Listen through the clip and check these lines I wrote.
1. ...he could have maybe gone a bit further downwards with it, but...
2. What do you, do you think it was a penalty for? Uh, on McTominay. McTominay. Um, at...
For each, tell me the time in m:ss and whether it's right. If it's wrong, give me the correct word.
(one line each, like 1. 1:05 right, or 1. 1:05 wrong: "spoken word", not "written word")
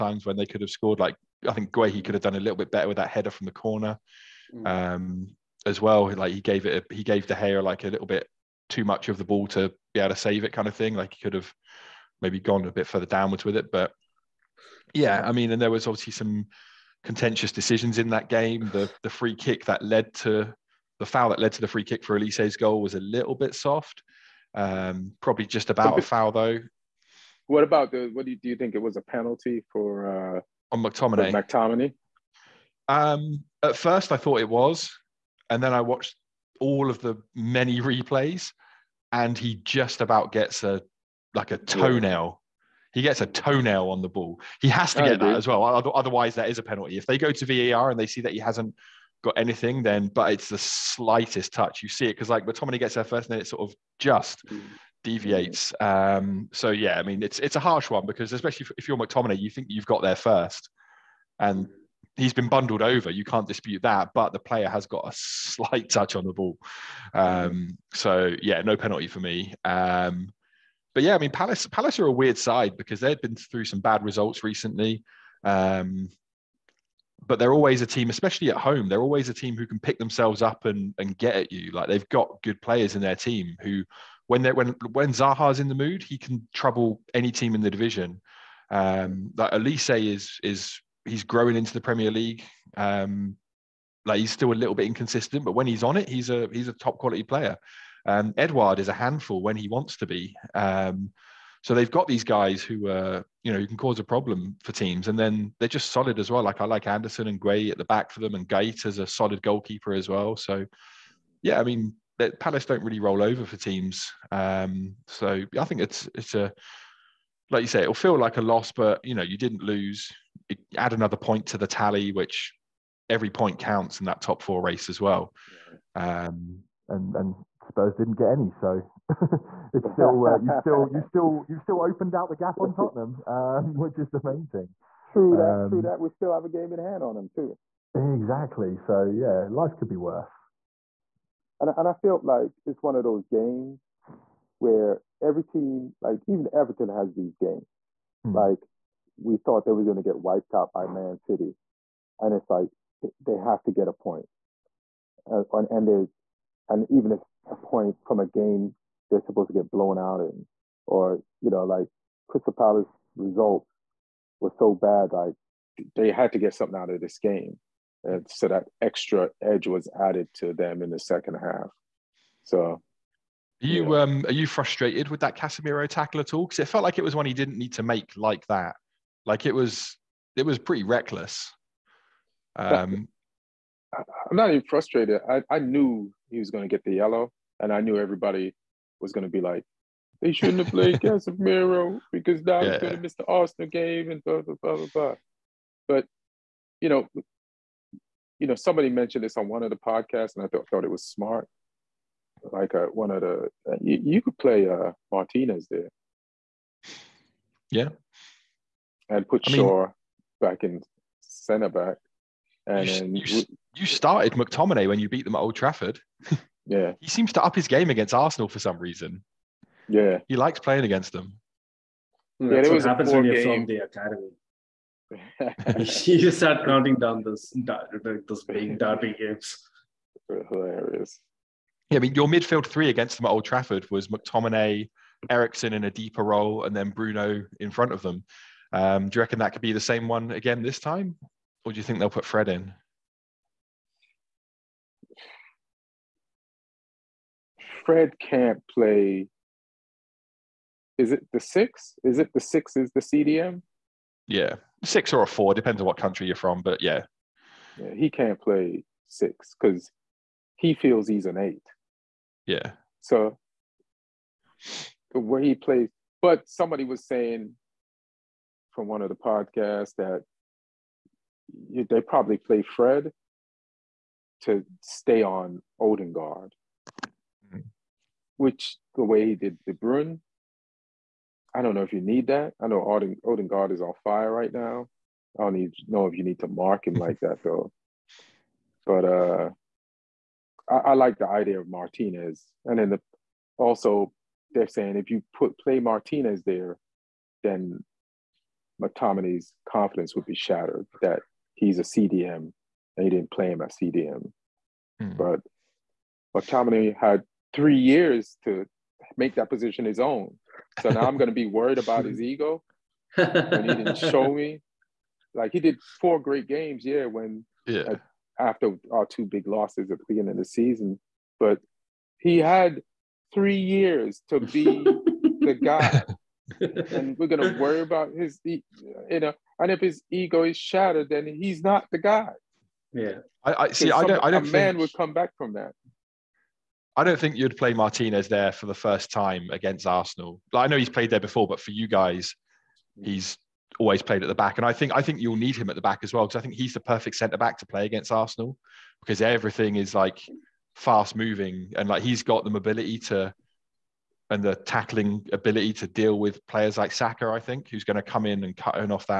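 1. 0:11 right
2. 0:28 right.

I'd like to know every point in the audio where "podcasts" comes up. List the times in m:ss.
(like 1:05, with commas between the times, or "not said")
3:19, 4:29.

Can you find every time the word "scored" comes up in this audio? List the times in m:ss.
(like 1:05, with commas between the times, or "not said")
0:00.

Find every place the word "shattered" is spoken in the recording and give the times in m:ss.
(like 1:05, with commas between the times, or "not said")
5:00, 5:30.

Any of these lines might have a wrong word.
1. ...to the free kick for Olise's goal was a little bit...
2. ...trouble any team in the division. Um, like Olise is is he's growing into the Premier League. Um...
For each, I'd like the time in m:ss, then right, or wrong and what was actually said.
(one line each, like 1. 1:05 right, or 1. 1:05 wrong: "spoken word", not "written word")
1. 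0:21 right
2. 1:26 right.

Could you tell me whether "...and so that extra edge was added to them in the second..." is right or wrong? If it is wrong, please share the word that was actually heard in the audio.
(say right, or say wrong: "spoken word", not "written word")
right.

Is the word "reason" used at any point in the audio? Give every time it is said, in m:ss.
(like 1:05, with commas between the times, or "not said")
3:38.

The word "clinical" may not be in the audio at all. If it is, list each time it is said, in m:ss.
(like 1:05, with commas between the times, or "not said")
not said.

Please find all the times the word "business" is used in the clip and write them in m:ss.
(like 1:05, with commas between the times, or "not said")
not said.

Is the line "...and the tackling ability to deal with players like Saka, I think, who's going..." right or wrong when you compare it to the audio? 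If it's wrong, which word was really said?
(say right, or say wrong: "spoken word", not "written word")
right.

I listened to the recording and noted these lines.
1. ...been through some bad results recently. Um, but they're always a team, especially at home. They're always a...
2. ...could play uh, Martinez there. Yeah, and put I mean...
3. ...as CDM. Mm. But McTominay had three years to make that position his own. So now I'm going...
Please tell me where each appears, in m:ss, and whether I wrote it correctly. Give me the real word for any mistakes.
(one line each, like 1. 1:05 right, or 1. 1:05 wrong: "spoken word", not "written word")
1. 1:13 right
2. 3:24 right
3. 5:03 right.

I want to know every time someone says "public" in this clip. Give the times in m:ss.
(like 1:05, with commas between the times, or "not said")
not said.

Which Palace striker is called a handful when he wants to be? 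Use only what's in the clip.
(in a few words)
Edouard.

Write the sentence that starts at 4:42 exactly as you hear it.
I know Oden, Odegaard is on fire right now.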